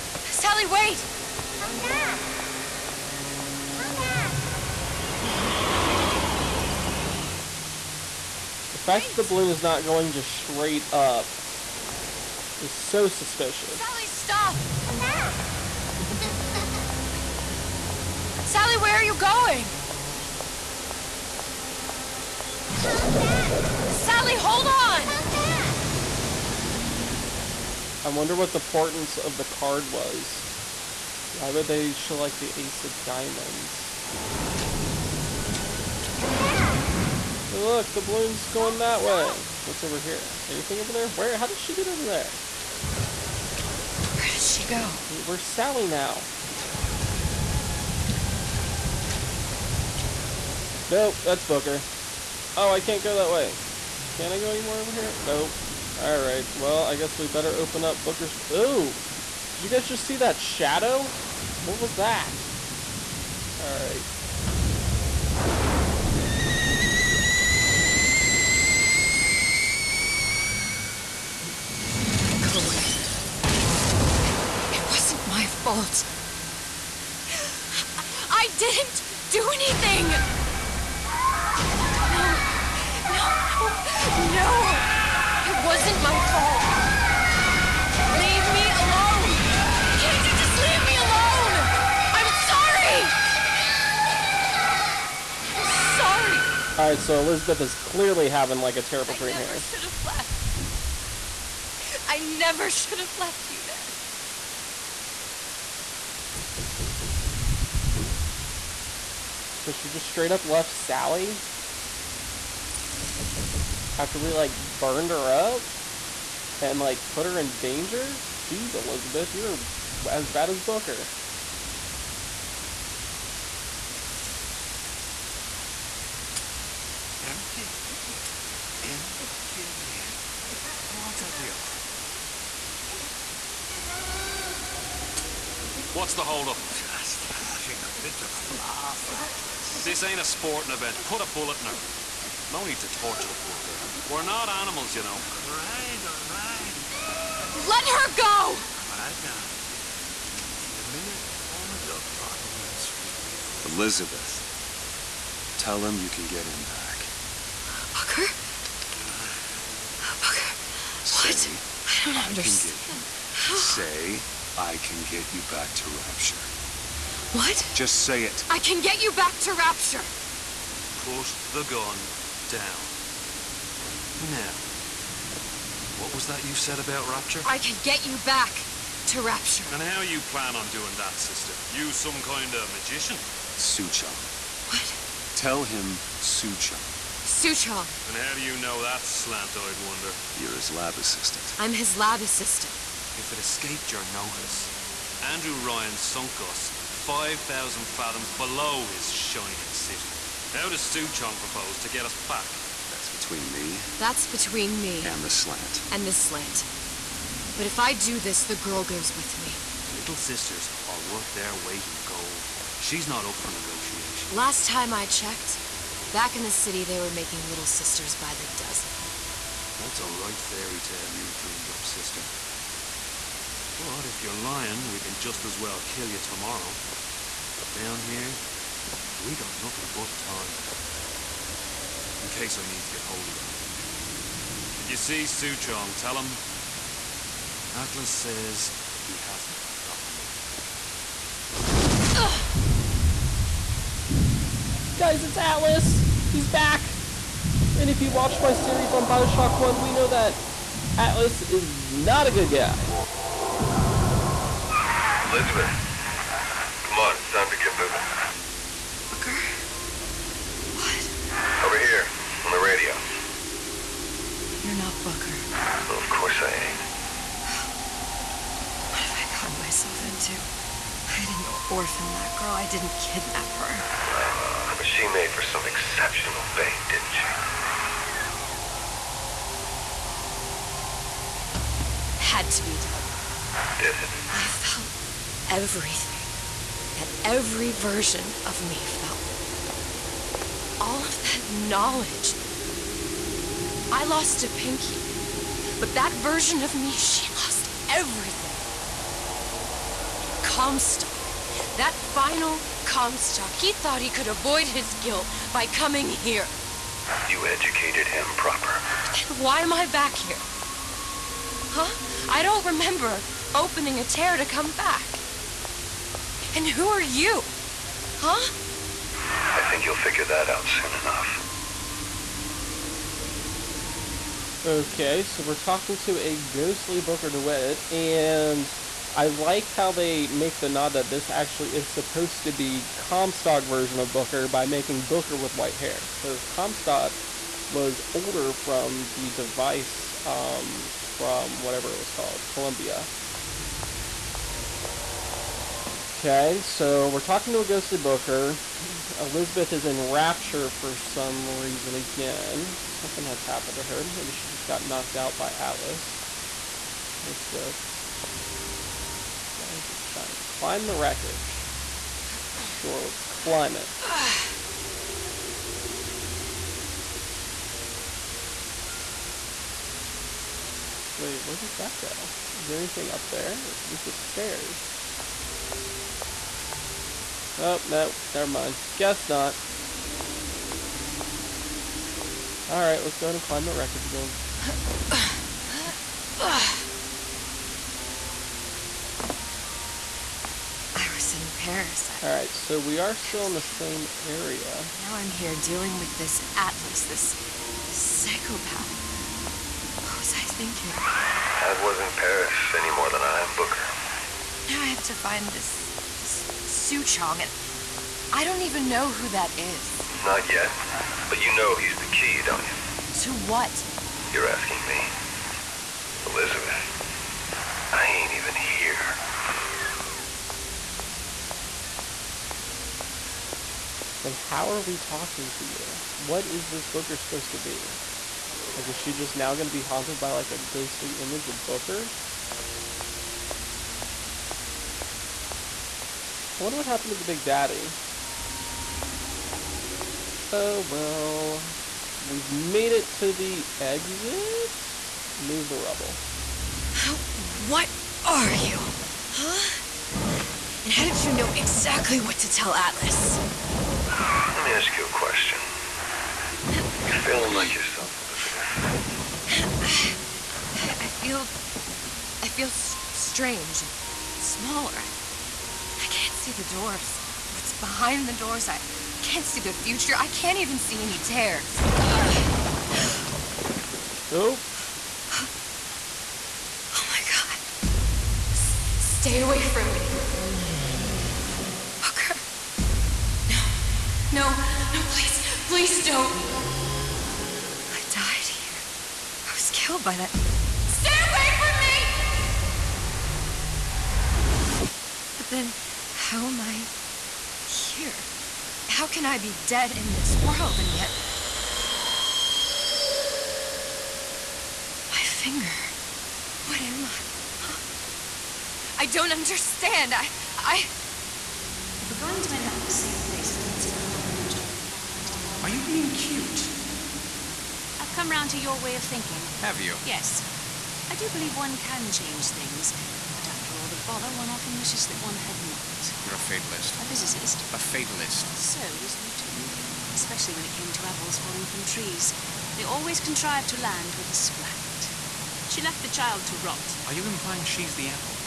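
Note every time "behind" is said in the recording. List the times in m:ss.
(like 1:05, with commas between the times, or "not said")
7:47.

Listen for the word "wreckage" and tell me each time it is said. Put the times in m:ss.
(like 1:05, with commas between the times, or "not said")
6:00, 6:23.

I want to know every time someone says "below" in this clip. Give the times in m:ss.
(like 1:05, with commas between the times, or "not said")
3:18.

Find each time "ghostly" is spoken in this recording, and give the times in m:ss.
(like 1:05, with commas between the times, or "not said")
5:26, 5:47, 7:10.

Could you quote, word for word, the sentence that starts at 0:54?
Can I go anymore over here?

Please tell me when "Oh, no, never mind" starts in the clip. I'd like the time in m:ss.
6:17.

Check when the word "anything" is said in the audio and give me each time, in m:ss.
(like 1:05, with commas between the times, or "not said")
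0:40, 1:19, 6:12.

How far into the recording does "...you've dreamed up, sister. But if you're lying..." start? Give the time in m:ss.
3:41.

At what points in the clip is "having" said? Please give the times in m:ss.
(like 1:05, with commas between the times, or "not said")
1:38, 2:17.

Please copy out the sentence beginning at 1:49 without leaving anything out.
So she just straight up left Sally?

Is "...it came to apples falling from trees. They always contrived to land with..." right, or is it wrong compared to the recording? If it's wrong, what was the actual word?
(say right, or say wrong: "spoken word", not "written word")
right.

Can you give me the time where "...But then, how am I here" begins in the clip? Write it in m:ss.
8:15.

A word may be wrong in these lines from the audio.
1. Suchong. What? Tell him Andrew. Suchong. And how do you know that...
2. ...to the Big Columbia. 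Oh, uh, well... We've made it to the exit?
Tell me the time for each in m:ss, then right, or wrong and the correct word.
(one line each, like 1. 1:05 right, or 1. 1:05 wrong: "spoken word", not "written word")
1. 3:03 wrong: "Suchong", not "Andrew"
2. 7:17 wrong: "Daddy", not "Columbia".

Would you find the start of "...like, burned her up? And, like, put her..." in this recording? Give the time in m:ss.
1:54.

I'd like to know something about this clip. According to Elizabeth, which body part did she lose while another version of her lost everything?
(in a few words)
A pinky.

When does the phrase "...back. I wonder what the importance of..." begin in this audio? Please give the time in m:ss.
0:25.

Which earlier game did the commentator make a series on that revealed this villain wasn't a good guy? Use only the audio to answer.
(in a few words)
Bioshock 1.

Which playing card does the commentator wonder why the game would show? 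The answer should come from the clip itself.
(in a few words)
Ace of diamonds.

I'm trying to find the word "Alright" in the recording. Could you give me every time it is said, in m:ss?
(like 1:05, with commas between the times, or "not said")
0:55, 1:03, 1:36, 6:22, 6:32.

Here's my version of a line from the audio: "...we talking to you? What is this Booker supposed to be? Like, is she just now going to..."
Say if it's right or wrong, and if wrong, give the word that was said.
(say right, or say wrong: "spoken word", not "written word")
right.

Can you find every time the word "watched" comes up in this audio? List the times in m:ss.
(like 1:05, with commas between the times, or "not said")
4:08.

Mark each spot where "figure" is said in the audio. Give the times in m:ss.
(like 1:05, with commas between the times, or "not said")
5:19.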